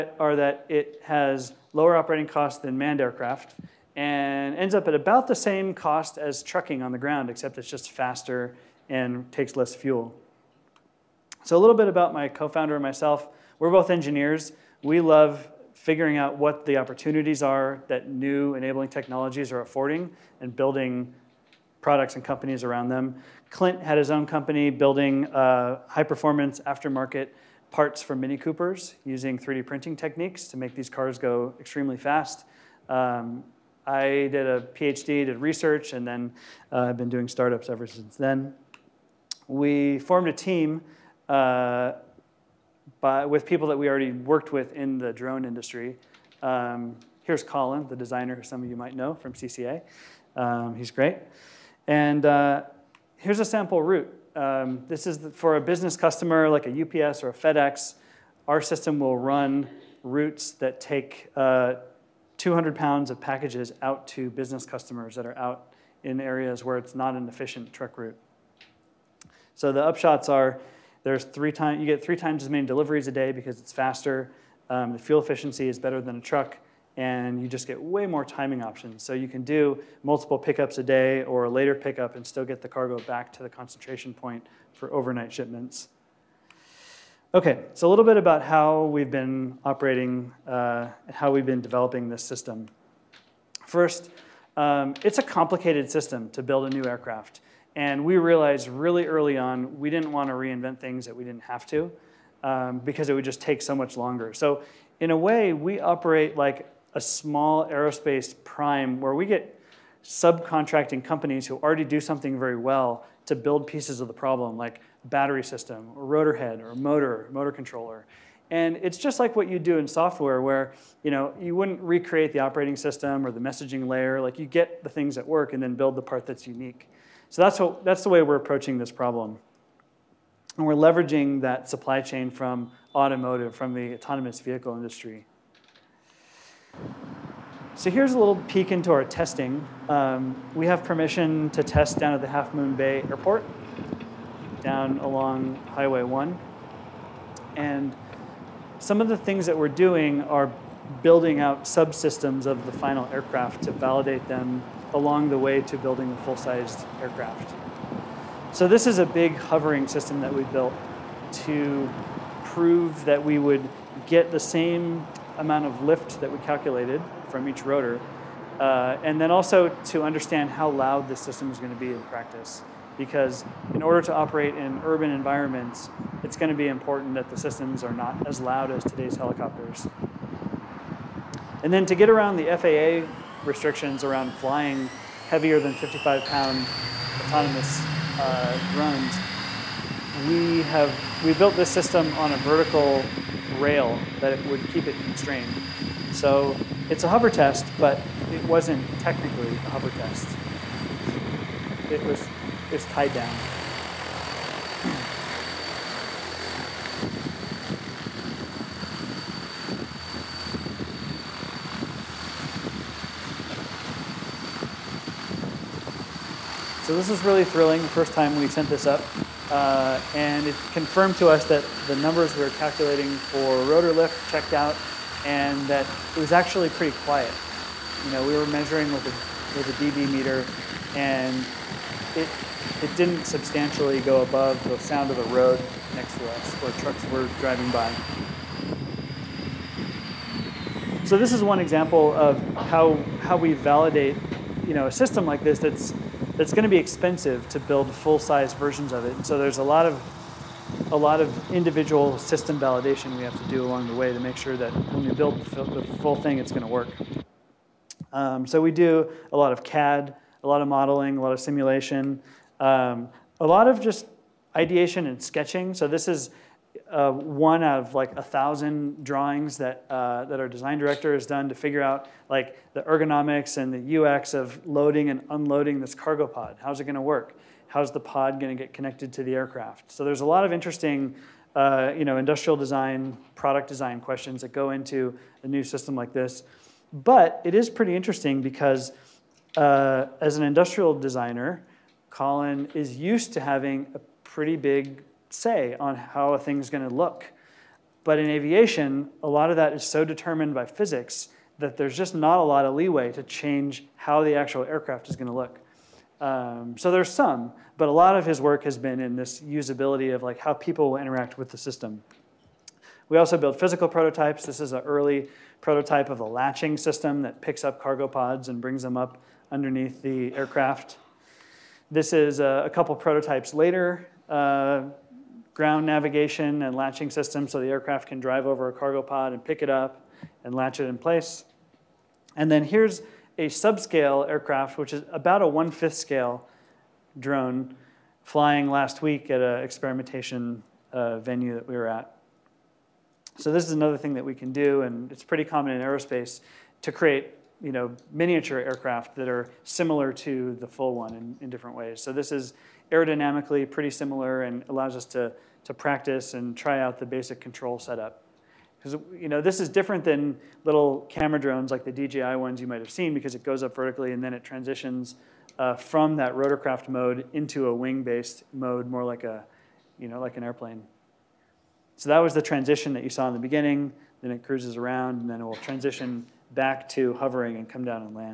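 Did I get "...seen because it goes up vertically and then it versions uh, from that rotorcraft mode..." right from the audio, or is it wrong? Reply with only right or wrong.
wrong.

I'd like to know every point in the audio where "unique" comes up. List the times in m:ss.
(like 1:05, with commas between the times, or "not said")
2:06.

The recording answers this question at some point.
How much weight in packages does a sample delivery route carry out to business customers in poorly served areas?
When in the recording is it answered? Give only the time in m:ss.
1:02.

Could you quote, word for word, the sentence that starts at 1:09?
So the upshots are there's three times you get three times as many deliveries a day because it's faster.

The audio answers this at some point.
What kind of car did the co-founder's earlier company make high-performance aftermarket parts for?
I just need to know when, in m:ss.
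0:28.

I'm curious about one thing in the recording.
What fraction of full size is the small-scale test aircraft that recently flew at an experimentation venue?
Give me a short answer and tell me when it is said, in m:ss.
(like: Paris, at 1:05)
one-fifth, at 5:35.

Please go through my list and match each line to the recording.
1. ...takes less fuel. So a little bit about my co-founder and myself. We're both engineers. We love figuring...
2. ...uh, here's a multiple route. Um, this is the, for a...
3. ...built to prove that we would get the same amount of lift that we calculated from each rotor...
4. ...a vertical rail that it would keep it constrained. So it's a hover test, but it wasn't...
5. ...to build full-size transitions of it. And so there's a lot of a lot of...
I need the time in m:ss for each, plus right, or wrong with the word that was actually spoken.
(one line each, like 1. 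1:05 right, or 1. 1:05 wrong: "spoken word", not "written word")
1. 0:09 right
2. 0:52 wrong: "sample", not "multiple"
3. 2:40 right
4. 3:12 right
5. 4:07 wrong: "versions", not "transitions".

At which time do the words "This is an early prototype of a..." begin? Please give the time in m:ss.
5:14.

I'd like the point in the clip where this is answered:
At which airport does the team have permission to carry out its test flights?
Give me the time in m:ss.
2:22.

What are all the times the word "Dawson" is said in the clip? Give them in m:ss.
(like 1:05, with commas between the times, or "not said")
not said.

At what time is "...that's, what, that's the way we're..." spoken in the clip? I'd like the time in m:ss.
2:07.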